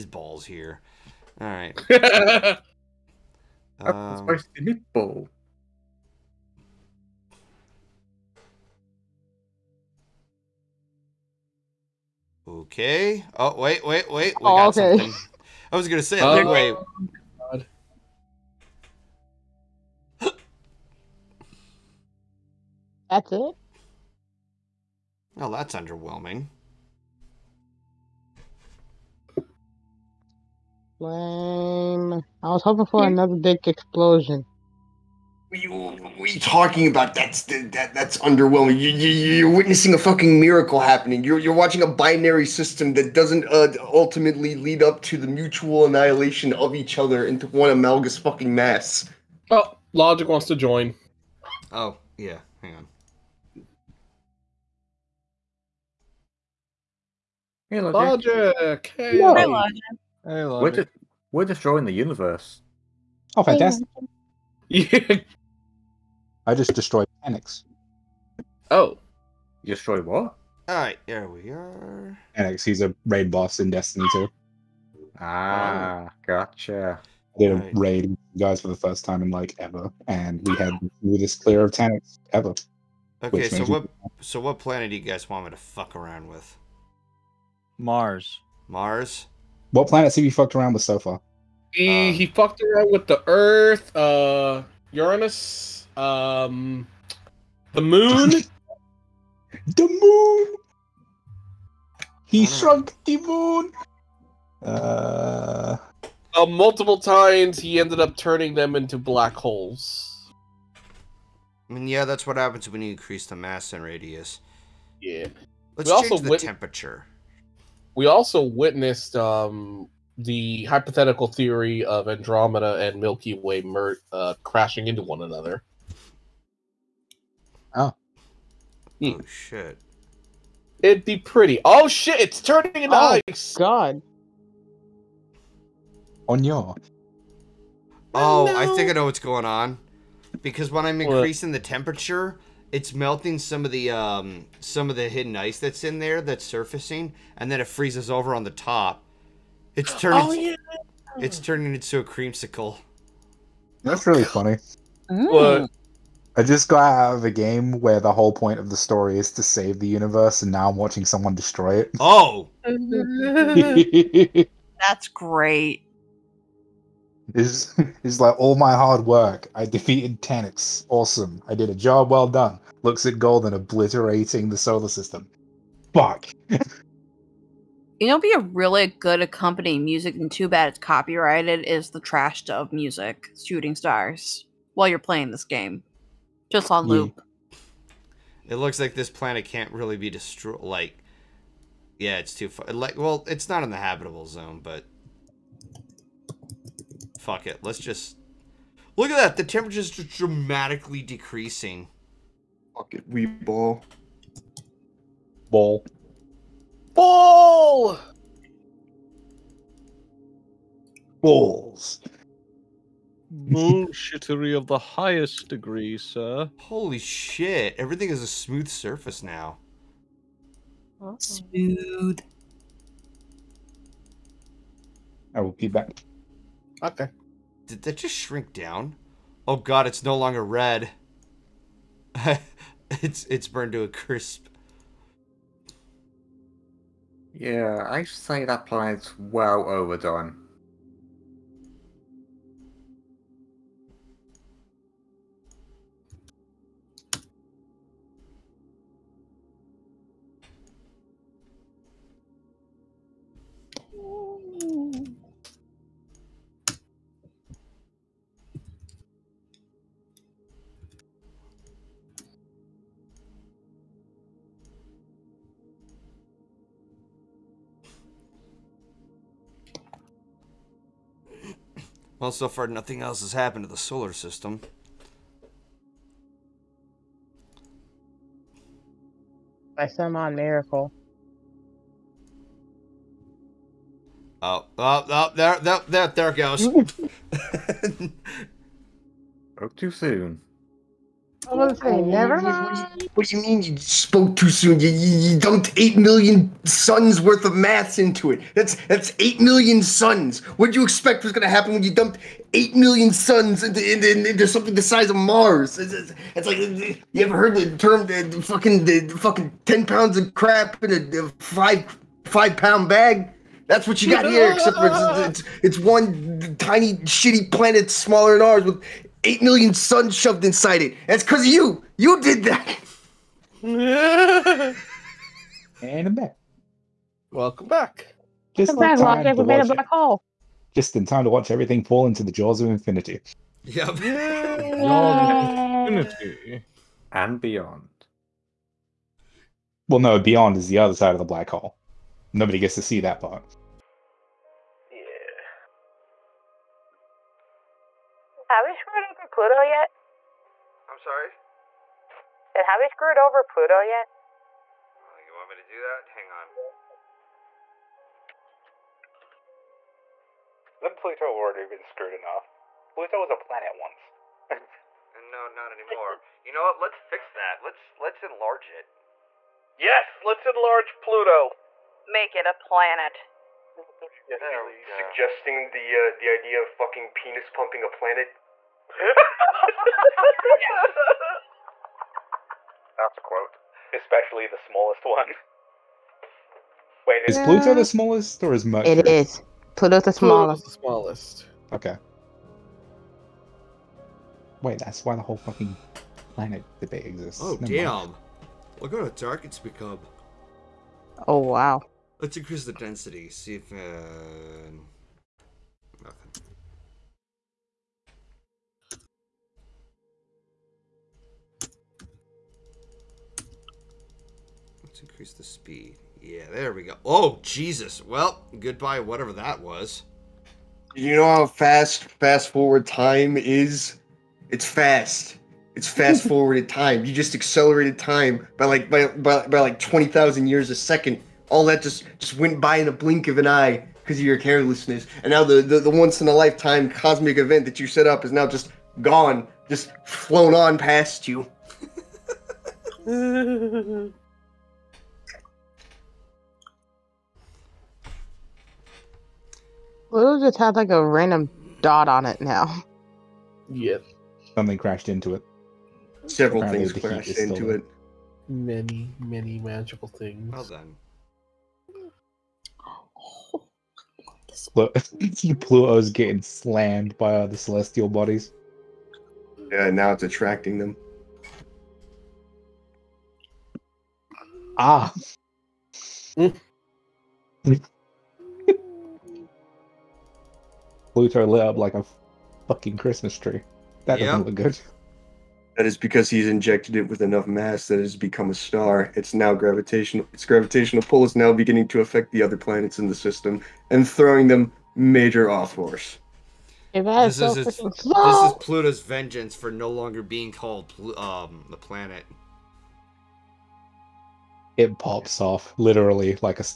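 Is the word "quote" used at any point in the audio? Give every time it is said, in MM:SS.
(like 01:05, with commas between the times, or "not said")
06:23.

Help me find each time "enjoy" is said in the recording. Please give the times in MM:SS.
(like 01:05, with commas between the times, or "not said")
not said.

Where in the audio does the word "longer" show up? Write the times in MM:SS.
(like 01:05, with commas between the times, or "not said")
03:50, 08:19.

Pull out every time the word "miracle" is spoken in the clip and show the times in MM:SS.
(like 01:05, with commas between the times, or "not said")
00:40, 04:40.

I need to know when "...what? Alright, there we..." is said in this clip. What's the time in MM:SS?
01:10.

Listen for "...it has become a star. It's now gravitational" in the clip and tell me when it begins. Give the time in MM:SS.
08:07.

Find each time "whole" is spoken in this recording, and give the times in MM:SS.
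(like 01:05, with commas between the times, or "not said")
02:38, 06:35.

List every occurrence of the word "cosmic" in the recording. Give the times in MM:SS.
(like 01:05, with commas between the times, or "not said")
07:16.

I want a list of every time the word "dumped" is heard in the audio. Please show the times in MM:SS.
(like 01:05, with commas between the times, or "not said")
04:55, 05:01.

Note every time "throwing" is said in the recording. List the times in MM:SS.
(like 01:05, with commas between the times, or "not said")
08:14.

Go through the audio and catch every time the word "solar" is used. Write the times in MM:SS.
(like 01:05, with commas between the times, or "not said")
02:54, 04:33.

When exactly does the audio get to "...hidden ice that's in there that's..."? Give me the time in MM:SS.
02:25.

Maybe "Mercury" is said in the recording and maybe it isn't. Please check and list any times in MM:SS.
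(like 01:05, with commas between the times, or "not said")
06:28.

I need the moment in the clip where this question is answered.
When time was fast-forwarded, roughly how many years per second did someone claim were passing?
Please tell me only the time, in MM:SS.
07:09.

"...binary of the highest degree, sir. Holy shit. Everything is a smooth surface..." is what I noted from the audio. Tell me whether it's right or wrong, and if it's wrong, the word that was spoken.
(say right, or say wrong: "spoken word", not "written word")
wrong: "bullshittery", not "binary".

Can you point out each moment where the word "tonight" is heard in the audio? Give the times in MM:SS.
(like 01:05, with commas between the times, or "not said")
not said.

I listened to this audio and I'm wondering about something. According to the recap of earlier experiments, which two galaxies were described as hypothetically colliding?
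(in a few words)
Andromeda and Milky Way.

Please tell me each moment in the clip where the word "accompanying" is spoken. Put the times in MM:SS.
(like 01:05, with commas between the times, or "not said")
02:59.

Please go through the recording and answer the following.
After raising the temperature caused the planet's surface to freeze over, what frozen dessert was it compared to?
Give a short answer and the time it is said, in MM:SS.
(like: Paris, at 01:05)
A creamsicle, at 02:31.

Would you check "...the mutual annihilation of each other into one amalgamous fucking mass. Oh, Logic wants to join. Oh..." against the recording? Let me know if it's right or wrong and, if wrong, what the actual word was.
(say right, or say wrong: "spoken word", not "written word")
right.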